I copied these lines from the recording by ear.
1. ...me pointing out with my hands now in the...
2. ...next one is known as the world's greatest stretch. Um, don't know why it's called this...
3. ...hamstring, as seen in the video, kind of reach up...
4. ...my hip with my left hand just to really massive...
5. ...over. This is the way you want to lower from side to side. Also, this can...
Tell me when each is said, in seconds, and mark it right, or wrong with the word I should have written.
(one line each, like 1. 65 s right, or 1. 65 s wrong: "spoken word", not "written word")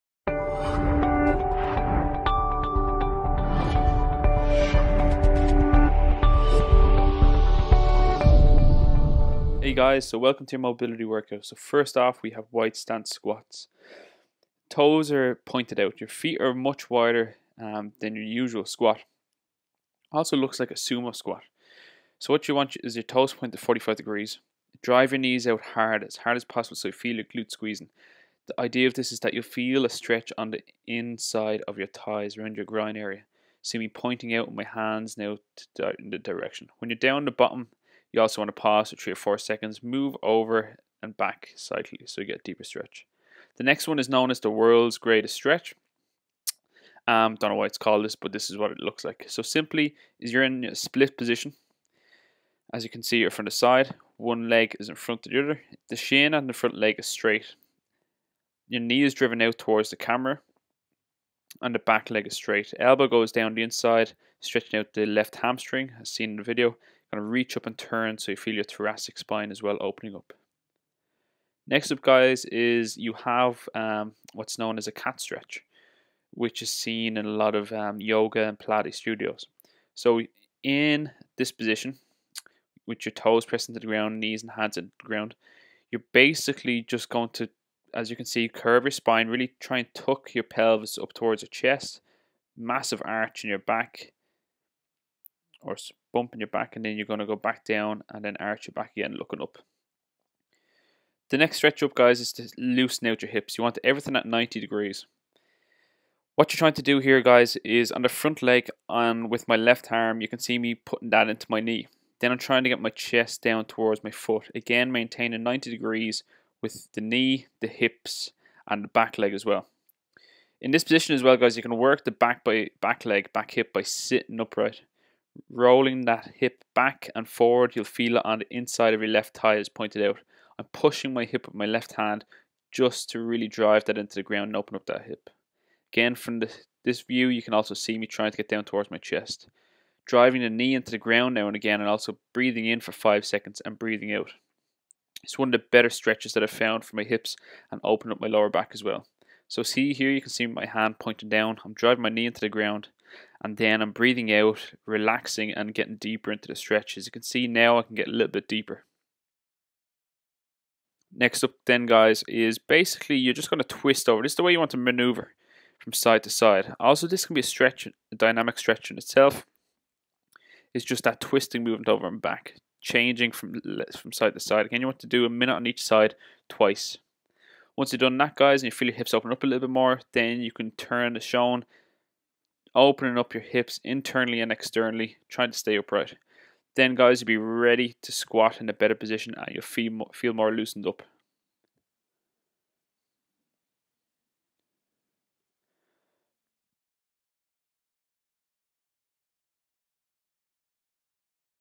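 1. 33 s right
2. 43 s right
3. 65 s right
4. 131 s wrong: "drive", not "massive"
5. 164 s wrong: "maneuver", not "lower".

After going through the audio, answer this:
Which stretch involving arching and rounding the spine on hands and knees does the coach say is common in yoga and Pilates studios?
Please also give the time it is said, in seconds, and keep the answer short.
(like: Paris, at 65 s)
cat stretch, at 74 s.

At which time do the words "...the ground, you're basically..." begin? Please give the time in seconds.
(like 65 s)
85 s.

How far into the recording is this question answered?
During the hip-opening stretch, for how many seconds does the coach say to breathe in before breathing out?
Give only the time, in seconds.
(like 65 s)
142 s.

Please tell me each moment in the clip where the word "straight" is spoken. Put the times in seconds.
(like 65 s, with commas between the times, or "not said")
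57 s, 62 s.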